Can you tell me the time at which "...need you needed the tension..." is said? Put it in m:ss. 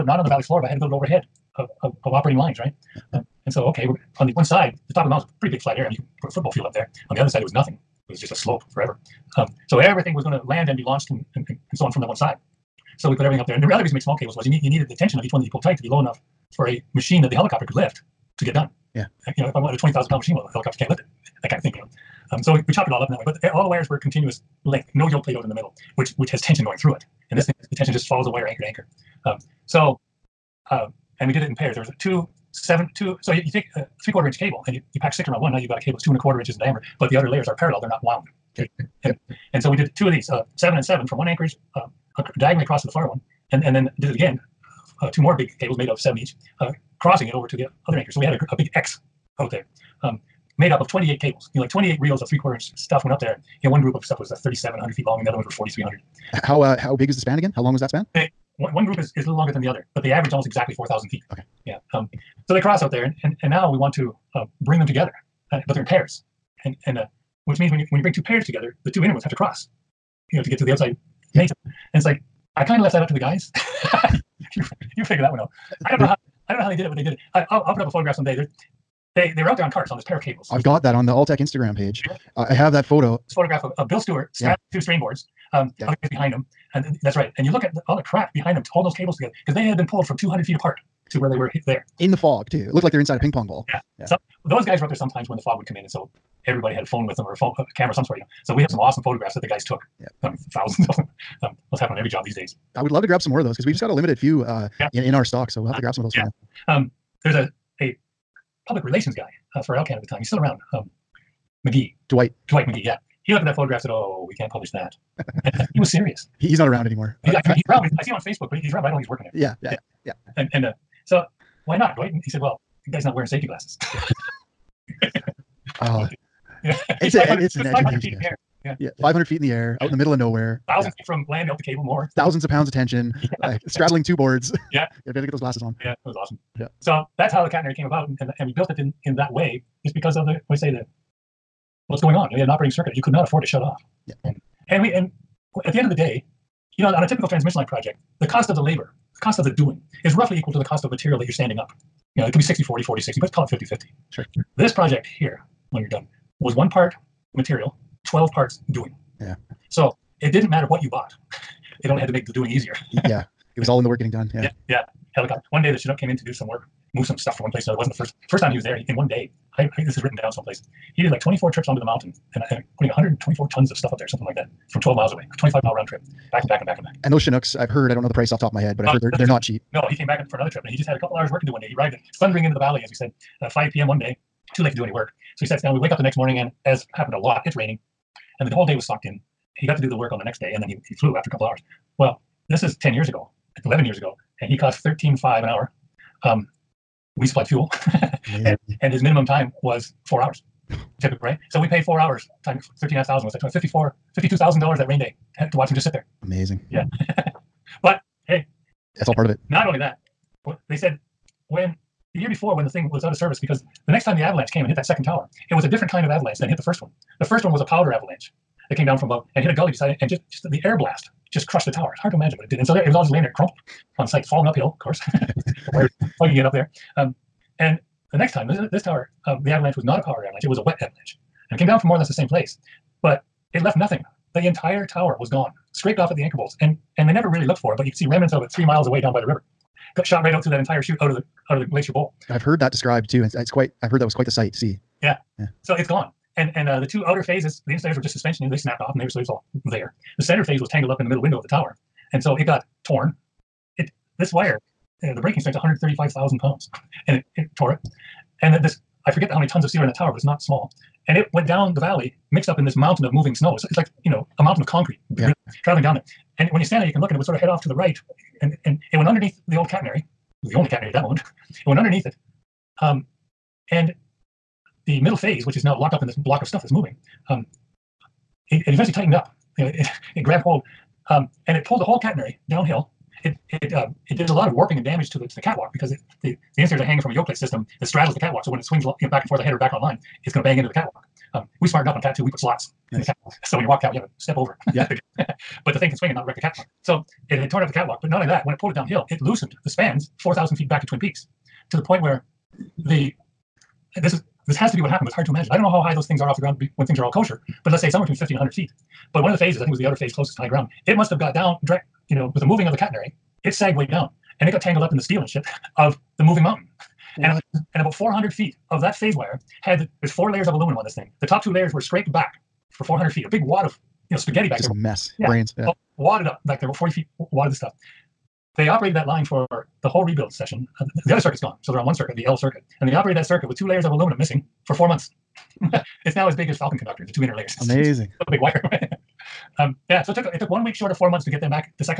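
0:14.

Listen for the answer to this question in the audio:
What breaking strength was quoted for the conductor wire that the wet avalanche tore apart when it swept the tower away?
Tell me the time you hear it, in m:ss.
4:15.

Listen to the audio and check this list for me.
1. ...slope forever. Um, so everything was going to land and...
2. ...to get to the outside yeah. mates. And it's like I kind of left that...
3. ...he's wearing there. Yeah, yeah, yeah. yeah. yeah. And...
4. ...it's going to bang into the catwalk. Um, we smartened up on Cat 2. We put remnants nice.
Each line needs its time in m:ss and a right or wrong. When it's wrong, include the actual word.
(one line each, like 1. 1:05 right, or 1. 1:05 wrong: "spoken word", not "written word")
1. 0:08 right
2. 1:10 right
3. 1:59 wrong: "working", not "wearing"
4. 4:50 wrong: "slots", not "remnants".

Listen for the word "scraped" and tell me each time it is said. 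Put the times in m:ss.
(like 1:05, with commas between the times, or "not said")
3:55, 5:21.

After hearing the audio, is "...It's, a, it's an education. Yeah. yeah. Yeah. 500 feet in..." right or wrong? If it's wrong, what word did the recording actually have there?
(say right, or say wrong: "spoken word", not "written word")
right.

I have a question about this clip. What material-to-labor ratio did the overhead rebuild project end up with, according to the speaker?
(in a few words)
1 part material, 12 parts doing.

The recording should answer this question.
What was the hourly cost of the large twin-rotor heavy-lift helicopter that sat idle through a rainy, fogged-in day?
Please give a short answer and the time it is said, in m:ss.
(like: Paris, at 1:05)
13.5 thousand an hour, at 3:14.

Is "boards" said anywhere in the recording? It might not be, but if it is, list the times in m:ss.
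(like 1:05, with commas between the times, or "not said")
1:24, 2:14.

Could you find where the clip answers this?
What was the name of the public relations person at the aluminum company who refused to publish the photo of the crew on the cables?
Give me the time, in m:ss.
1:52.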